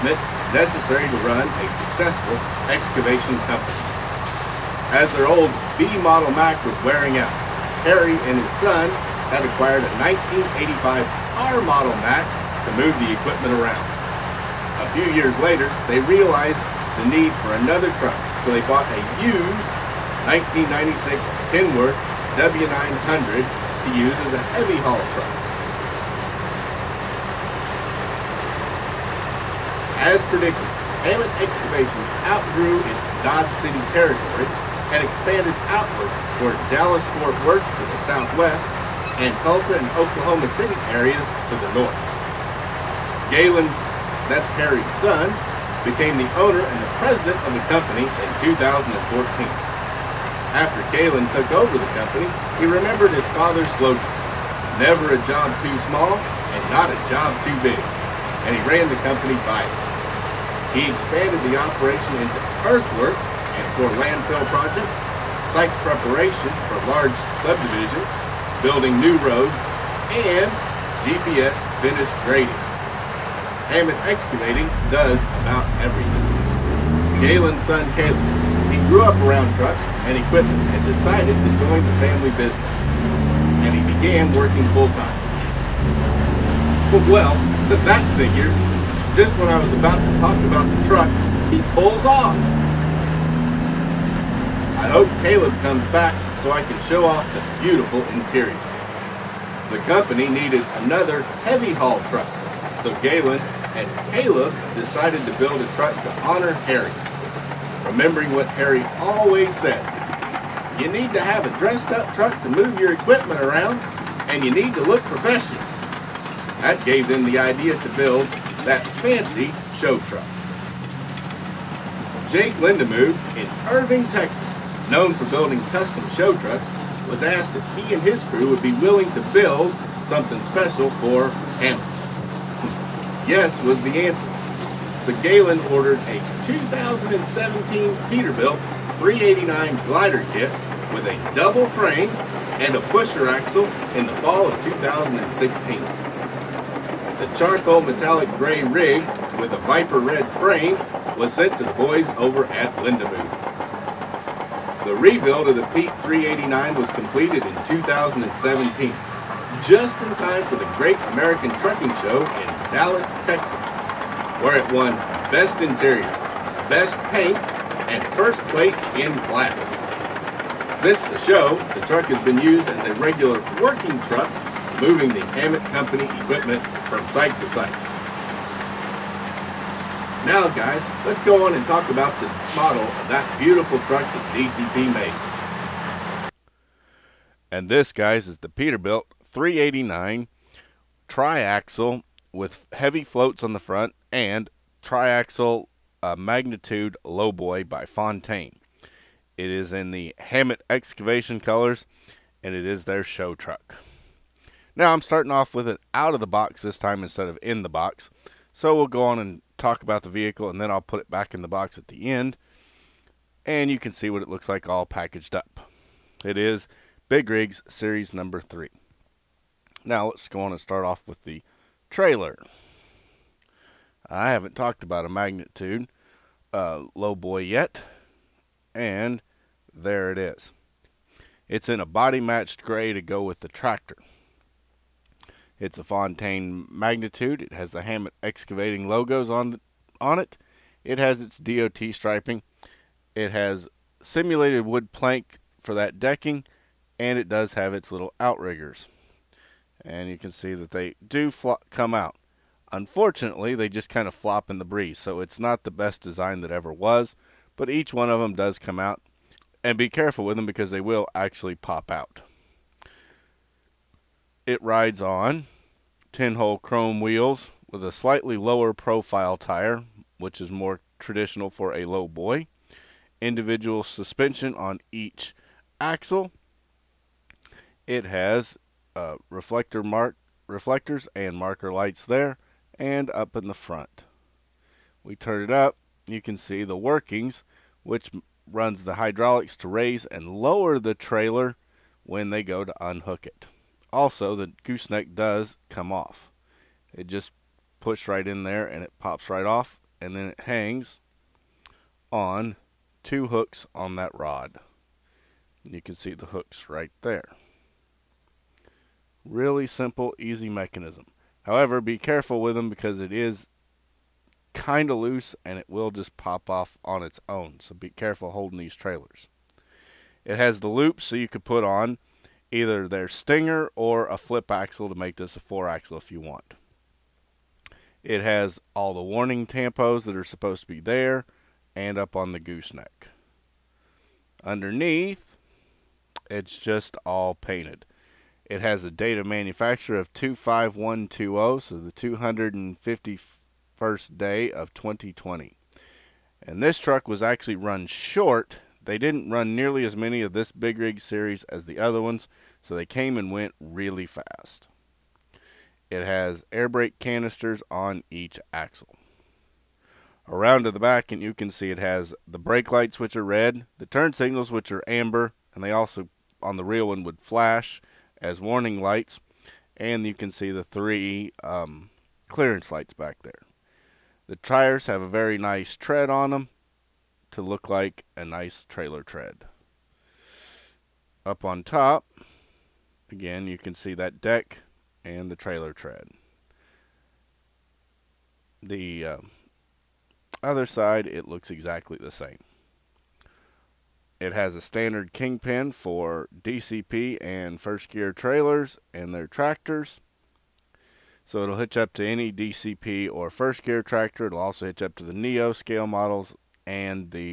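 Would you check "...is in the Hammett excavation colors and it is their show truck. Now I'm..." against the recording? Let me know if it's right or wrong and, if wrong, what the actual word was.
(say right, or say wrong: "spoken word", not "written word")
right.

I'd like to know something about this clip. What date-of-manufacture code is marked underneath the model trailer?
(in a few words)
25120.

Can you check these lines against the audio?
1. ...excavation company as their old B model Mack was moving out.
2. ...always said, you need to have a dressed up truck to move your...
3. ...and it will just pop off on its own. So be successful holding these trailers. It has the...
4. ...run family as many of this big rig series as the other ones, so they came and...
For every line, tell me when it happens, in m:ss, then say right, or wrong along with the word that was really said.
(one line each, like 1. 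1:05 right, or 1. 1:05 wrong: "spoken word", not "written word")
1. 0:02 wrong: "wearing", not "moving"
2. 1:48 right
3. 5:15 wrong: "careful", not "successful"
4. 5:49 wrong: "nearly", not "family".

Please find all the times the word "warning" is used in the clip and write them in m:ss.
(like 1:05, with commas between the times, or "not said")
5:29, 6:08.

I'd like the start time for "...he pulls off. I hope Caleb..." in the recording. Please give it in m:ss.
1:31.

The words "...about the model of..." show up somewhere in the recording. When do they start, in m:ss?
3:01.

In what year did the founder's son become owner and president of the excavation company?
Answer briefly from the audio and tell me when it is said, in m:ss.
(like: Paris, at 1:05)
2014, at 0:48.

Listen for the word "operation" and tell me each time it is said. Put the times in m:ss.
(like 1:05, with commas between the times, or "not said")
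1:01.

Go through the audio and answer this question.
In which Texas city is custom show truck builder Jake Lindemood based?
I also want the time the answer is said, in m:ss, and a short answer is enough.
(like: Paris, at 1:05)
Irving, Texas, at 2:03.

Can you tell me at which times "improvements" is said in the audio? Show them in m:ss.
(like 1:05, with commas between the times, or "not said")
not said.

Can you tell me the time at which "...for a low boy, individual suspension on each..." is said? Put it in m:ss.
4:31.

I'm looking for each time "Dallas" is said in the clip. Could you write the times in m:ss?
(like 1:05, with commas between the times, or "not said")
0:36, 2:42.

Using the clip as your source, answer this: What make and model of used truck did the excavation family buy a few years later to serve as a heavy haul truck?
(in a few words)
1996 Kenworth W900.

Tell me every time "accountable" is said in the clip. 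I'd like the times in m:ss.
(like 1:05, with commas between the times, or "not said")
not said.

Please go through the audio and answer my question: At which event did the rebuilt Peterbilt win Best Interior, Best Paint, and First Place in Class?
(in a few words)
Great American Trucking Show.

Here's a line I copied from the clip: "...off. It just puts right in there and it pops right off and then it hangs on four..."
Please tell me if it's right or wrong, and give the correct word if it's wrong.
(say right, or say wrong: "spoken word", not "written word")
wrong: "two", not "four".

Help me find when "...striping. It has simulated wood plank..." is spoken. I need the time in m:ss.
4:01.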